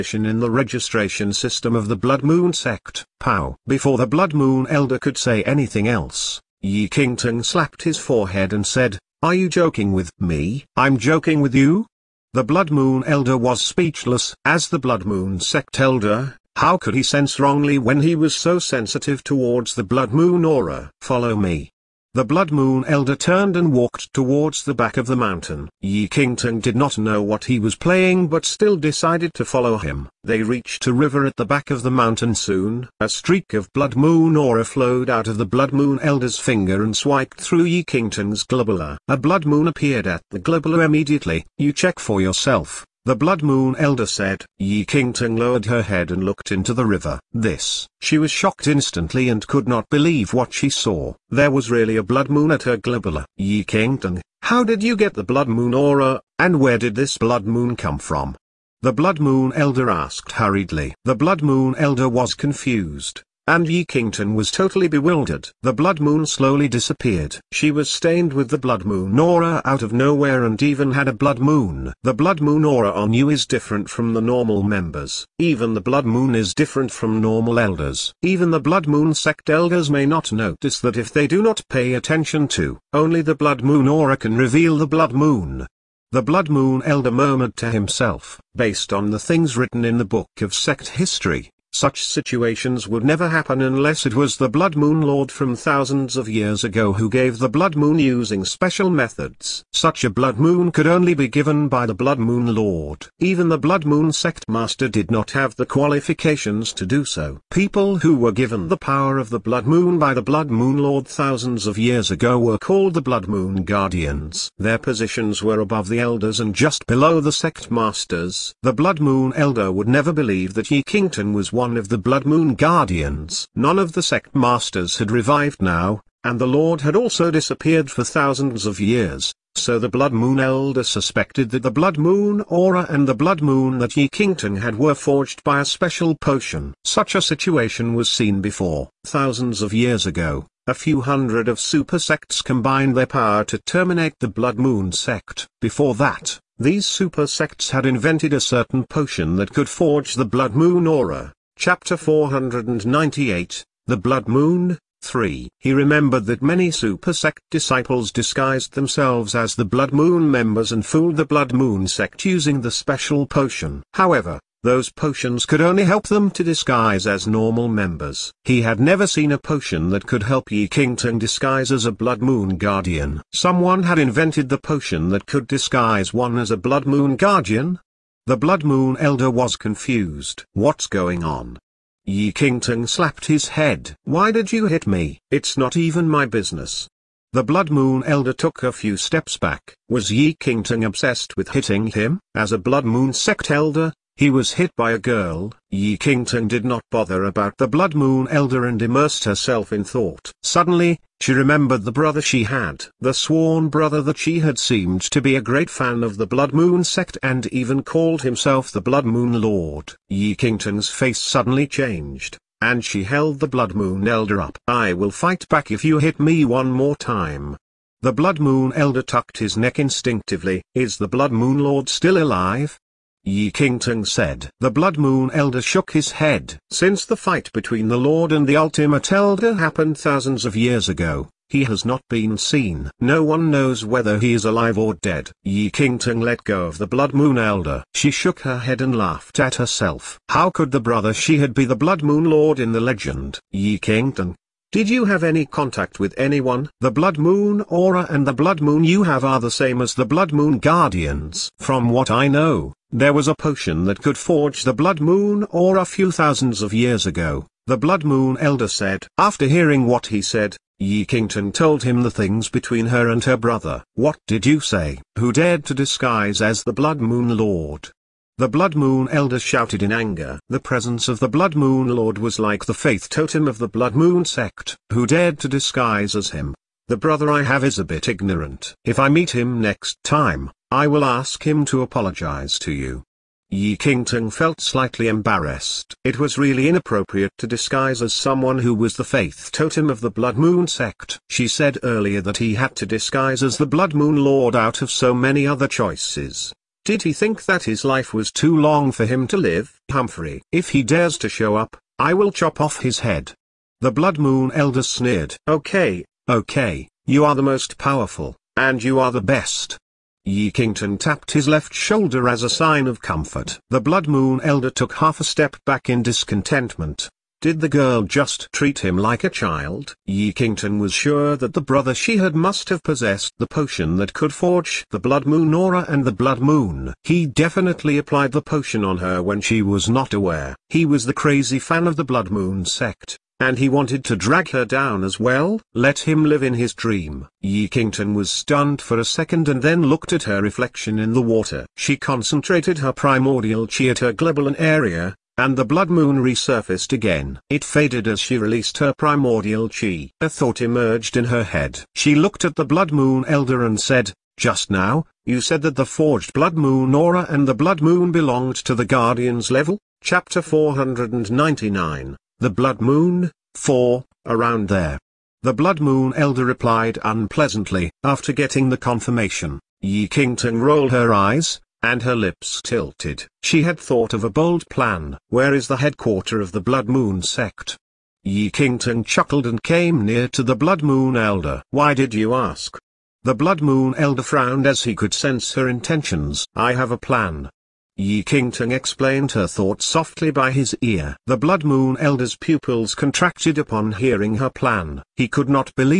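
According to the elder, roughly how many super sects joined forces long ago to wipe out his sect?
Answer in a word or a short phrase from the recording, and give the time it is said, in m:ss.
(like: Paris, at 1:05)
A few hundred, at 2:20.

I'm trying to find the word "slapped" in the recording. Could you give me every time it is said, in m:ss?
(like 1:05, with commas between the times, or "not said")
0:07, 3:02.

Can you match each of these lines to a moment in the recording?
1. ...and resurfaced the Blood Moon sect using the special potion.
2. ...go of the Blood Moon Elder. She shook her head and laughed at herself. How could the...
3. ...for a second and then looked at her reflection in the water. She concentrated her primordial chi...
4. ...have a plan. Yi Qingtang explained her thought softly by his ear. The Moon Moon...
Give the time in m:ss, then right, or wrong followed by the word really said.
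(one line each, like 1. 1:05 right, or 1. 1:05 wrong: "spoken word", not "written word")
1. 2:40 wrong: "fooled", not "resurfaced"
2. 3:56 right
3. 5:38 right
4. 6:26 wrong: "Blood", not "Moon".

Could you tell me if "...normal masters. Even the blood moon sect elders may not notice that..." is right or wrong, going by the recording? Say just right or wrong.
wrong.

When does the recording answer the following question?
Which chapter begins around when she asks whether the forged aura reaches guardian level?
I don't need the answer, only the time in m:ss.
6:00.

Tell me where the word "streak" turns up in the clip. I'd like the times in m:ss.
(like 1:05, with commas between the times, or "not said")
0:33.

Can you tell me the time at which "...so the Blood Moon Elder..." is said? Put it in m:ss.
2:09.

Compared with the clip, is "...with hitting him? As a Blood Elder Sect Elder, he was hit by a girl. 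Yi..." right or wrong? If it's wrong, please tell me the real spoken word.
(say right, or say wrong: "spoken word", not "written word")
wrong: "Moon", not "Elder".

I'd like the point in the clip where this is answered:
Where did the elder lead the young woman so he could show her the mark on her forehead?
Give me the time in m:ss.
0:30.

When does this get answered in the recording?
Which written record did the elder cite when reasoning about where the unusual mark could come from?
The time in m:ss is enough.
1:30.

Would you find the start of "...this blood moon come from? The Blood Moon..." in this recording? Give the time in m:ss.
0:56.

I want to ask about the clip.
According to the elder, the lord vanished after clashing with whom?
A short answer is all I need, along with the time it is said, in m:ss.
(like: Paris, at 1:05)
The Ultimate Elder, at 3:48.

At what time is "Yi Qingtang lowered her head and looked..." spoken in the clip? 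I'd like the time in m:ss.
0:44.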